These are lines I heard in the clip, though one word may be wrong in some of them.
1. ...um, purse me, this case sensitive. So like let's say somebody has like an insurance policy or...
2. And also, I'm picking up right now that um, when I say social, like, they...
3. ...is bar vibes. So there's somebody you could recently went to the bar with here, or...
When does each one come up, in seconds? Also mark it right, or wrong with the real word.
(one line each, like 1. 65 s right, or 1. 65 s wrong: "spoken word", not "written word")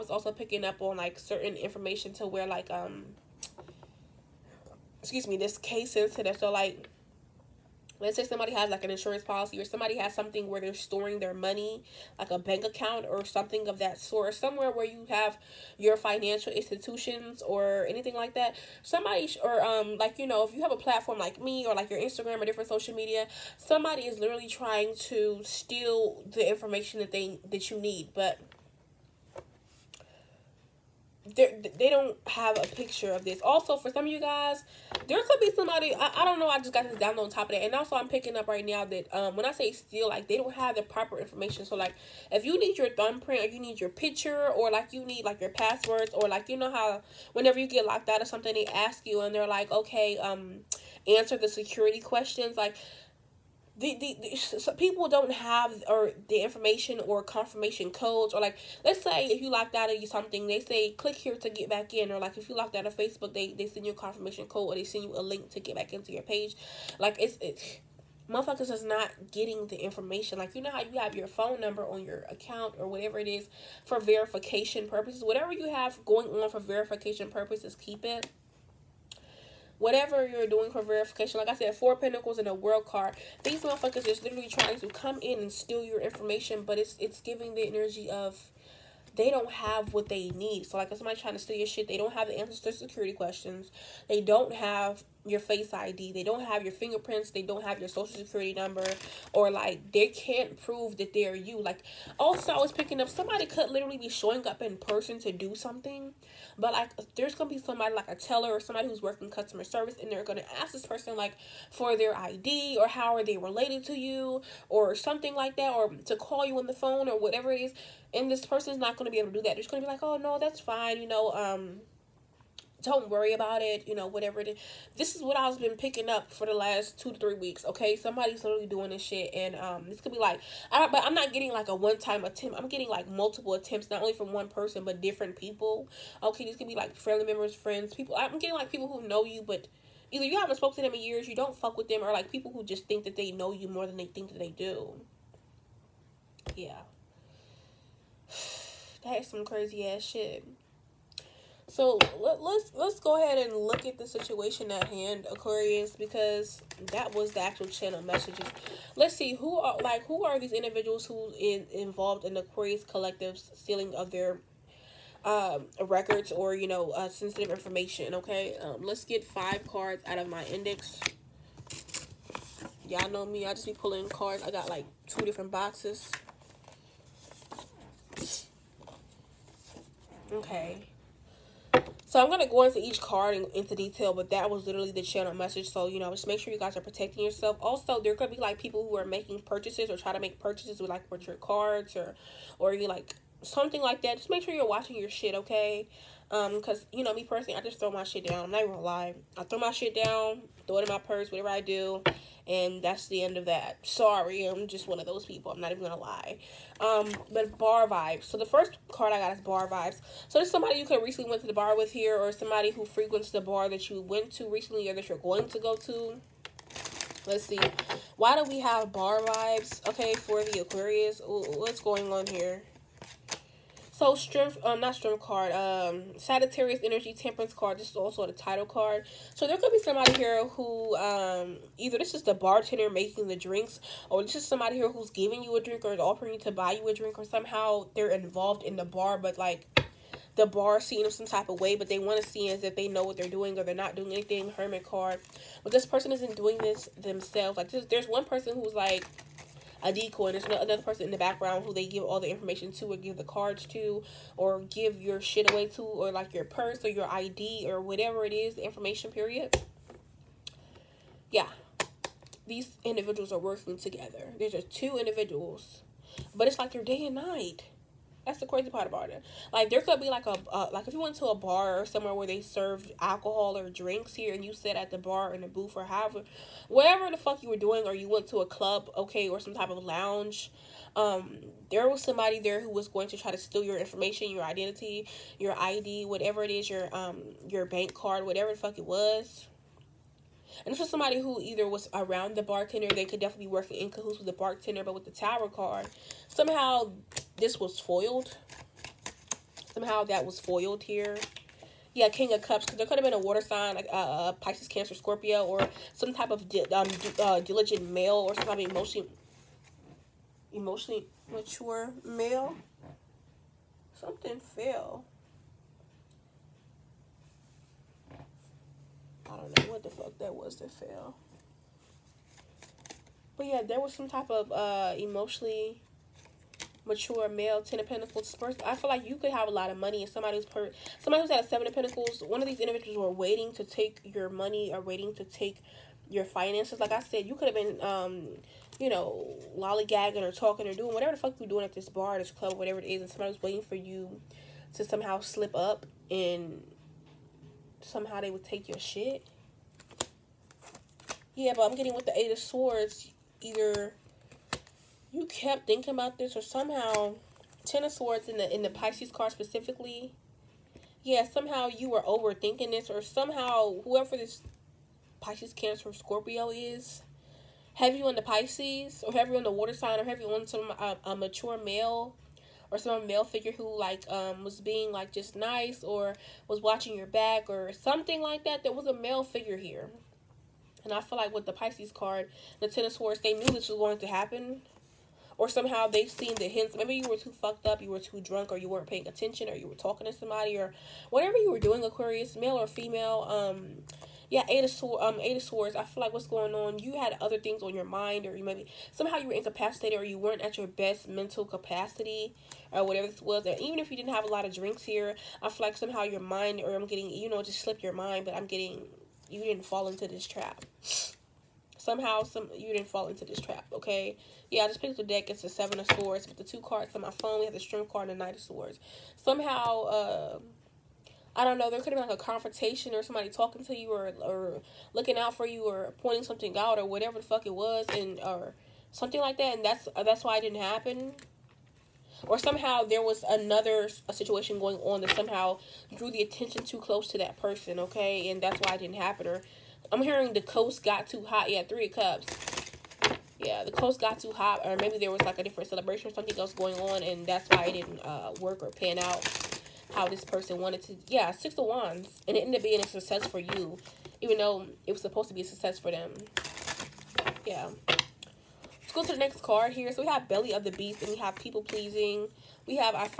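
1. 2 s wrong: "excuse", not "purse"
2. 37 s wrong: "steal", not "social"
3. 209 s right.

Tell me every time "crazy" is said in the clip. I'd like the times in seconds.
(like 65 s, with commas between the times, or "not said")
149 s, 268 s.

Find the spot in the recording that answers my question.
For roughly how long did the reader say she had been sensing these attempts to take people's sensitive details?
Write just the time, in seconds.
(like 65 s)
126 s.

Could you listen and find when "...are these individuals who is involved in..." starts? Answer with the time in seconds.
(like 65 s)
160 s.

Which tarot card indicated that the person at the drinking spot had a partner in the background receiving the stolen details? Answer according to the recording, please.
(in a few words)
Hermit.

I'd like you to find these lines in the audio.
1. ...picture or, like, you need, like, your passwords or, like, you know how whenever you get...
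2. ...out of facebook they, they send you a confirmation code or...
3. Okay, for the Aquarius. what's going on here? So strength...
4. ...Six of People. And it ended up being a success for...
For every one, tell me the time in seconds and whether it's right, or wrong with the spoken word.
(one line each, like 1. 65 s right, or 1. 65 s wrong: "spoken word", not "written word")
1. 43 s right
2. 62 s right
3. 219 s right
4. 451 s wrong: "Wands", not "People".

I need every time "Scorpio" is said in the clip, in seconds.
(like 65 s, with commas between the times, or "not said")
304 s, 365 s.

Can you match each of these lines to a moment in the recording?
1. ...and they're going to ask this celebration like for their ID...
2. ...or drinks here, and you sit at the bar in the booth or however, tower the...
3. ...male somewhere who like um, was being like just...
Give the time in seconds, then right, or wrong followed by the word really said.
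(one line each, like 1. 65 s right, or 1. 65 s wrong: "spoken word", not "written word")
1. 110 s wrong: "person", not "celebration"
2. 273 s wrong: "whatever", not "tower"
3. 373 s wrong: "figure", not "somewhere".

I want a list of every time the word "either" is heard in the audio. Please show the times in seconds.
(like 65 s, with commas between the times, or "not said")
140 s, 231 s, 291 s, 353 s.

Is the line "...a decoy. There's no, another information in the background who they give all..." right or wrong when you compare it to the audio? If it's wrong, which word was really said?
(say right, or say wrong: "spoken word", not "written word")
wrong: "person", not "information".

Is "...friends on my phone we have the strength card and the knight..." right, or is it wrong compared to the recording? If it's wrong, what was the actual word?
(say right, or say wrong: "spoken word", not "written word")
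wrong: "cards", not "friends".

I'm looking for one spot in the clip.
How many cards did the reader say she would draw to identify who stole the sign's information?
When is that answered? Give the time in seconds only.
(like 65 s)
169 s.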